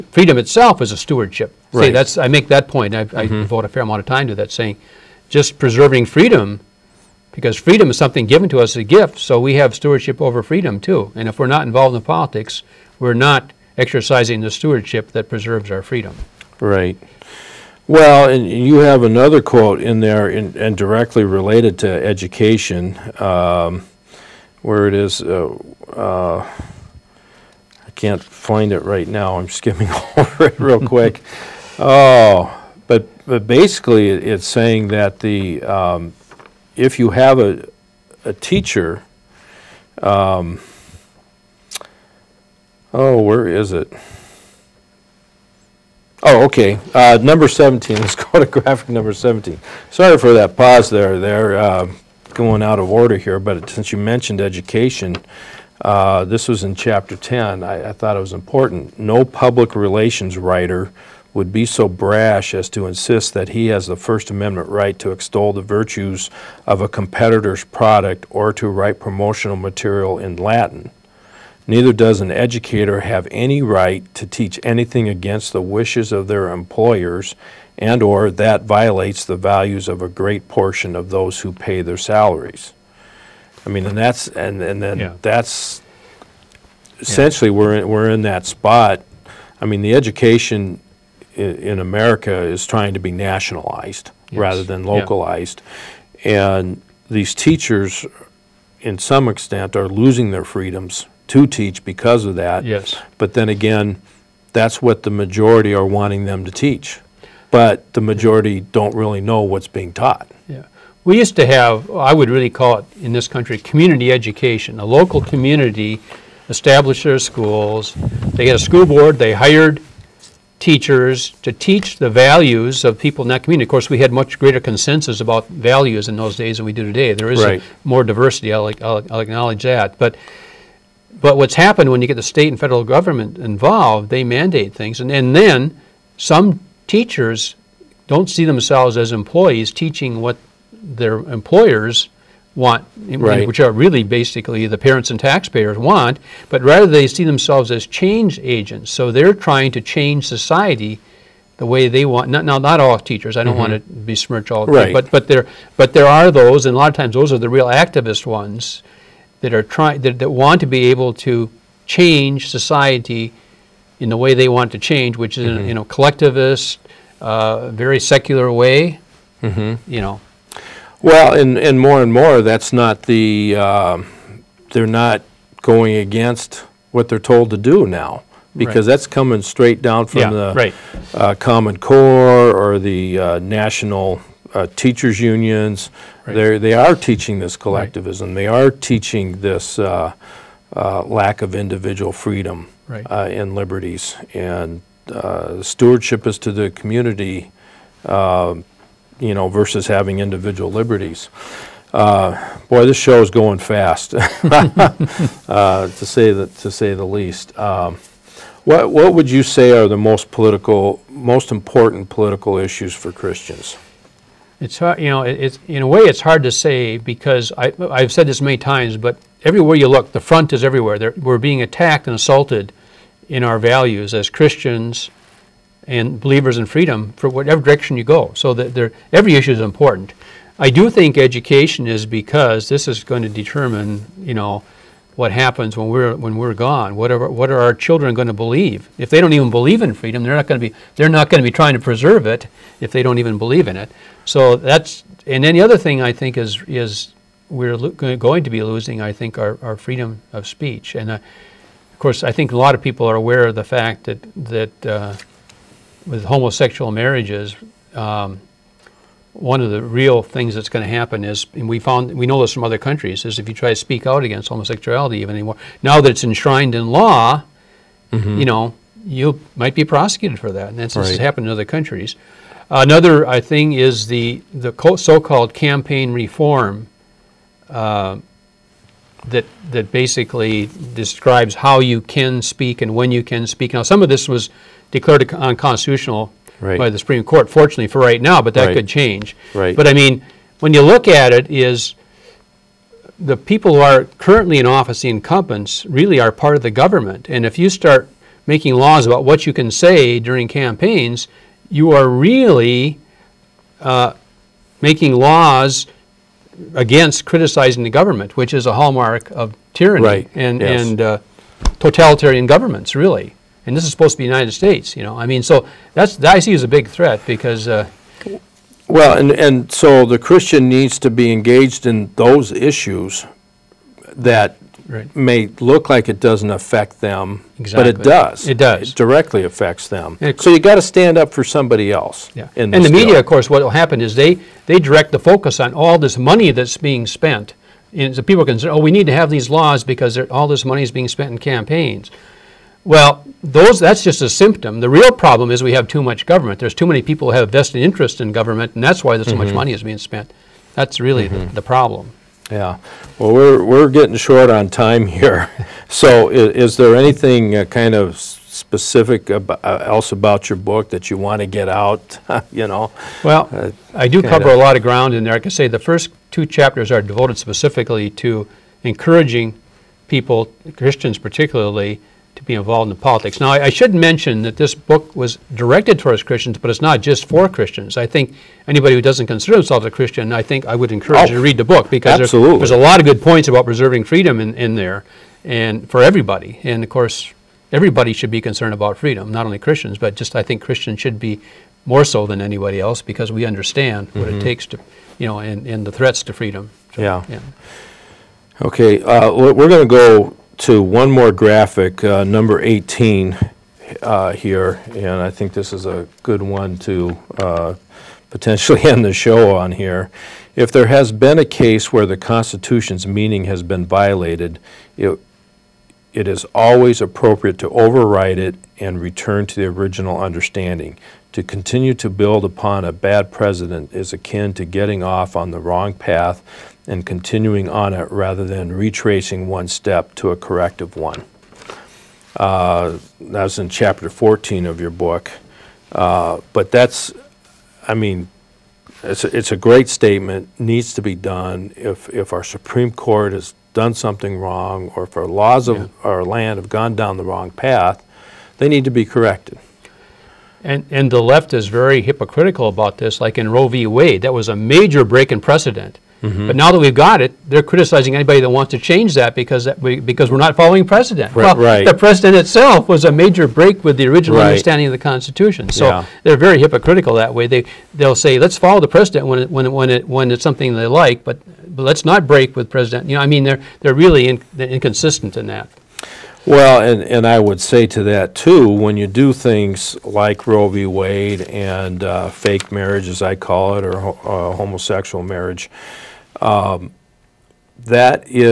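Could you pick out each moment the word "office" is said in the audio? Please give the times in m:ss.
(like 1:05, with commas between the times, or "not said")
4:54.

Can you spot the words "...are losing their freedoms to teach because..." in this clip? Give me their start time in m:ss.
1:39.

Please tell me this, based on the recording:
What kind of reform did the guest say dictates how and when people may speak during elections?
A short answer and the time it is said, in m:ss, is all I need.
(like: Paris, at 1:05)
Campaign reform, at 4:35.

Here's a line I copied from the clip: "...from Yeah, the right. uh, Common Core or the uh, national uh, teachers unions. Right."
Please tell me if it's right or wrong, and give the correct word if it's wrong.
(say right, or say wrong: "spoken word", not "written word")
right.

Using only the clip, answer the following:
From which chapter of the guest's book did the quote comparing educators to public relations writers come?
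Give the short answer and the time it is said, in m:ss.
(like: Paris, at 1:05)
Chapter 10, at 0:56.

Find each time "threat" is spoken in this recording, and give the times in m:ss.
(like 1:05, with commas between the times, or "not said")
5:16, 6:35.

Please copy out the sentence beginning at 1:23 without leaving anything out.
I mean, and that's and and then yeah.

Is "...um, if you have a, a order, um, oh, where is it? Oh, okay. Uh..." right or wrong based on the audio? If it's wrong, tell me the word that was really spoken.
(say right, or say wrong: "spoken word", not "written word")
wrong: "teacher", not "order".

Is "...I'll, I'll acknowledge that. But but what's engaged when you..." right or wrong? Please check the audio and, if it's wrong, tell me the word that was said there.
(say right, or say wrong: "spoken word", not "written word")
wrong: "happened", not "engaged".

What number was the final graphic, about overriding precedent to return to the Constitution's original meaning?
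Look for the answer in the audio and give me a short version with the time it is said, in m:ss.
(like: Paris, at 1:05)
18, at 6:42.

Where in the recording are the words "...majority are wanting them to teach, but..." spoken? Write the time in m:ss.
1:45.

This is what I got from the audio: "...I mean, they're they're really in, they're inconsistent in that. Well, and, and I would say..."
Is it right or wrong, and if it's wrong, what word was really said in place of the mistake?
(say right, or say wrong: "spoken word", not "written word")
right.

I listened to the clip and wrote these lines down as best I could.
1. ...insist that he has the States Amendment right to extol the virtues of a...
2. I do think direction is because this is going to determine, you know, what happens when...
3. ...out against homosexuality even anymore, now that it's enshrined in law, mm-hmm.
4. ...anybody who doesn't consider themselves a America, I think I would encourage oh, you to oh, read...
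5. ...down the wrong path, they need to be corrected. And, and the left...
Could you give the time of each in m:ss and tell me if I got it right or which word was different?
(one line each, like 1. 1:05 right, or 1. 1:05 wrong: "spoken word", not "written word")
1. 1:02 wrong: "First", not "States"
2. 3:50 wrong: "education", not "direction"
3. 4:24 right
4. 6:18 wrong: "Christian", not "America"
5. 7:26 right.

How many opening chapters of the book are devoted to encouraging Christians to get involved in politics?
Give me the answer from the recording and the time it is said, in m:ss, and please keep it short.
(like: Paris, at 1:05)
2, at 6:06.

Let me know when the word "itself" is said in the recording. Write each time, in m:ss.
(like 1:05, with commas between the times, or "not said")
0:00, 7:42.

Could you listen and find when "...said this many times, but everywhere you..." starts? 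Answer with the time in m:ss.
3:38.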